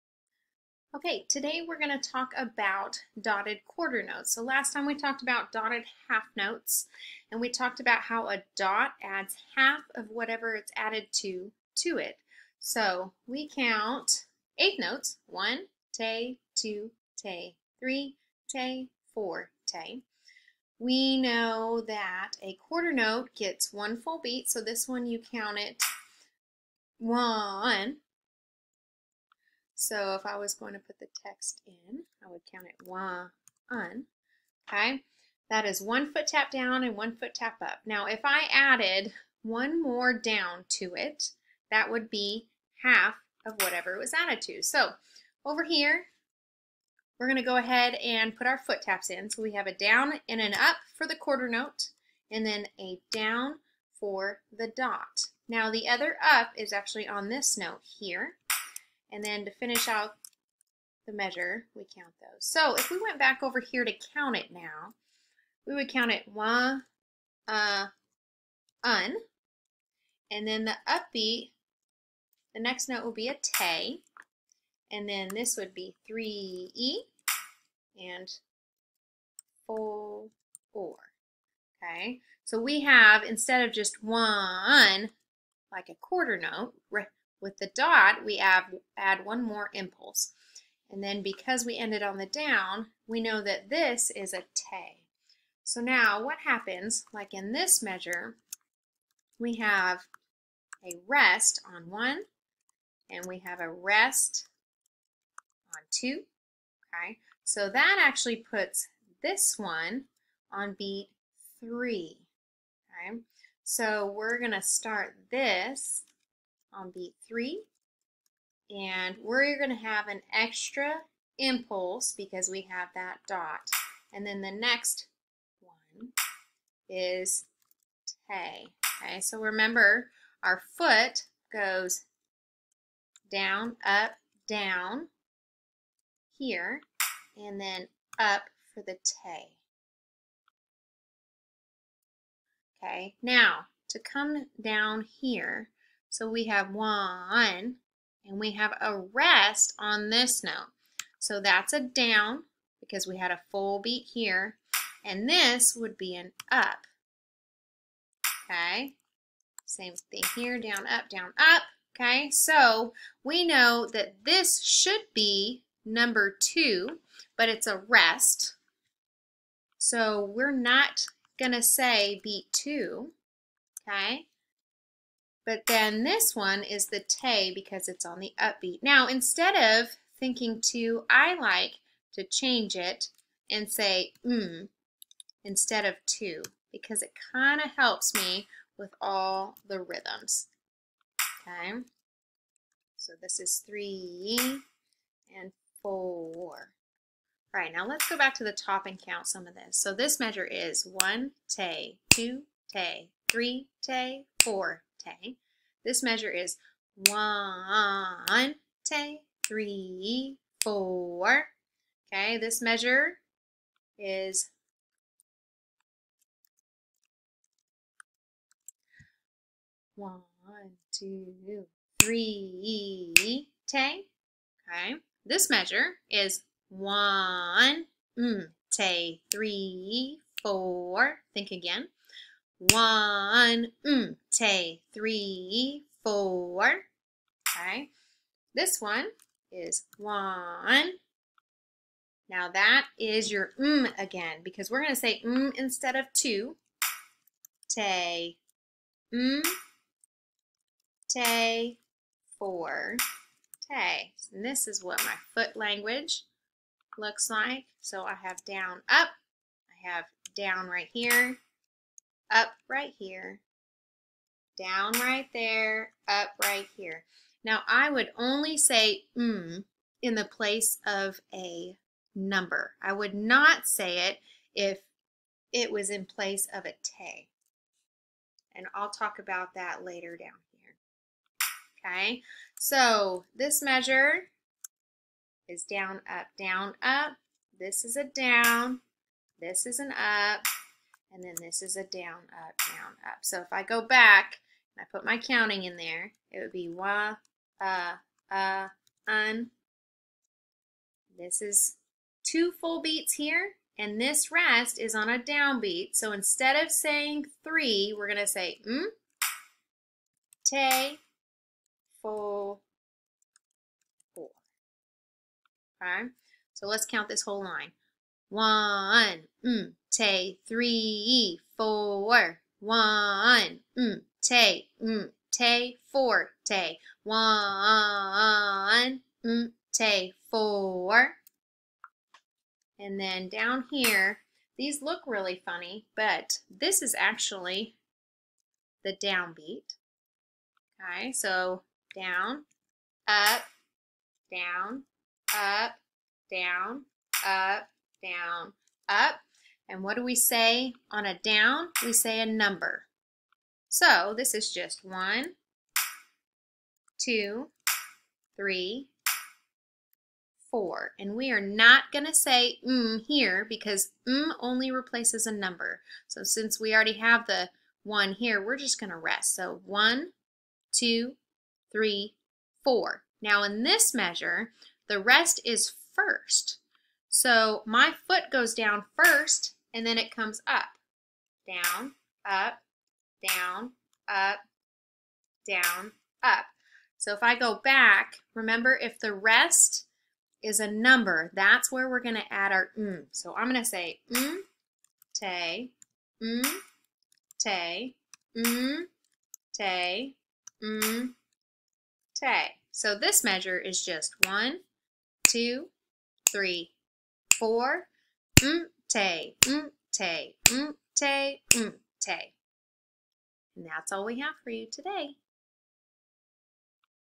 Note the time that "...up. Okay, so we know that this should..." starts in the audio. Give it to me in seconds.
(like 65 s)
161 s.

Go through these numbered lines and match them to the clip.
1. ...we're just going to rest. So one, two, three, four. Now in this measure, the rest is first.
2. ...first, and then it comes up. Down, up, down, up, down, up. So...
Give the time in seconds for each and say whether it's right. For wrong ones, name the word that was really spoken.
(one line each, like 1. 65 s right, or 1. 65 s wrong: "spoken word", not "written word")
1. 368 s right
2. 378 s right.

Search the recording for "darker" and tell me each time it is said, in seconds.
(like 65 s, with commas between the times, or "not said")
not said.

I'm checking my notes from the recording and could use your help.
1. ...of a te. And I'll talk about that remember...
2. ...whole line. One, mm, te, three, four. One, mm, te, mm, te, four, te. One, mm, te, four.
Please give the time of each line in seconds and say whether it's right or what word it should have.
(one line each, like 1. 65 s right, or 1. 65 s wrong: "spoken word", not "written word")
1. 276 s wrong: "later", not "remember"
2. 317 s right.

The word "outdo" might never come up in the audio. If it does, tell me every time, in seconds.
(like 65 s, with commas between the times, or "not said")
not said.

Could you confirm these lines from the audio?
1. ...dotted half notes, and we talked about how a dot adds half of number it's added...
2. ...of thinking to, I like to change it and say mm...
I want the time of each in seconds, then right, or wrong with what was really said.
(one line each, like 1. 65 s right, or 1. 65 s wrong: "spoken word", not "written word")
1. 5 s wrong: "whatever", not "number"
2. 179 s right.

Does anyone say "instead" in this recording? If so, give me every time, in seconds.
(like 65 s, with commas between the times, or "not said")
83 s, 179 s, 185 s, 245 s, 306 s.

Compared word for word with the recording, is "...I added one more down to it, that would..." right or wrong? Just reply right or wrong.
right.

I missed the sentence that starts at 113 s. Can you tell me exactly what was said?
So we're gonna start this on beat three.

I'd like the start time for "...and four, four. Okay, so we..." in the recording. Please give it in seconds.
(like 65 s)
78 s.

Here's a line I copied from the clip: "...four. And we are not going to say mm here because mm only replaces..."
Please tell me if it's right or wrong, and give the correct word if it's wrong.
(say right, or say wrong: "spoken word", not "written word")
right.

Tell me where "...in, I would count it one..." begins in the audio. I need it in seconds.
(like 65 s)
31 s.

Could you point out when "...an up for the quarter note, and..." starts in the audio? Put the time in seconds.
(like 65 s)
50 s.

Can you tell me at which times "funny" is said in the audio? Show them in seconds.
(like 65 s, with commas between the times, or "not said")
335 s.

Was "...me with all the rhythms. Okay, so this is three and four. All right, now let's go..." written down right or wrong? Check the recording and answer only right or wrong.
right.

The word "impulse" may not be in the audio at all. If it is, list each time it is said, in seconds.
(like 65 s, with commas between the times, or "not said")
89 s, 121 s.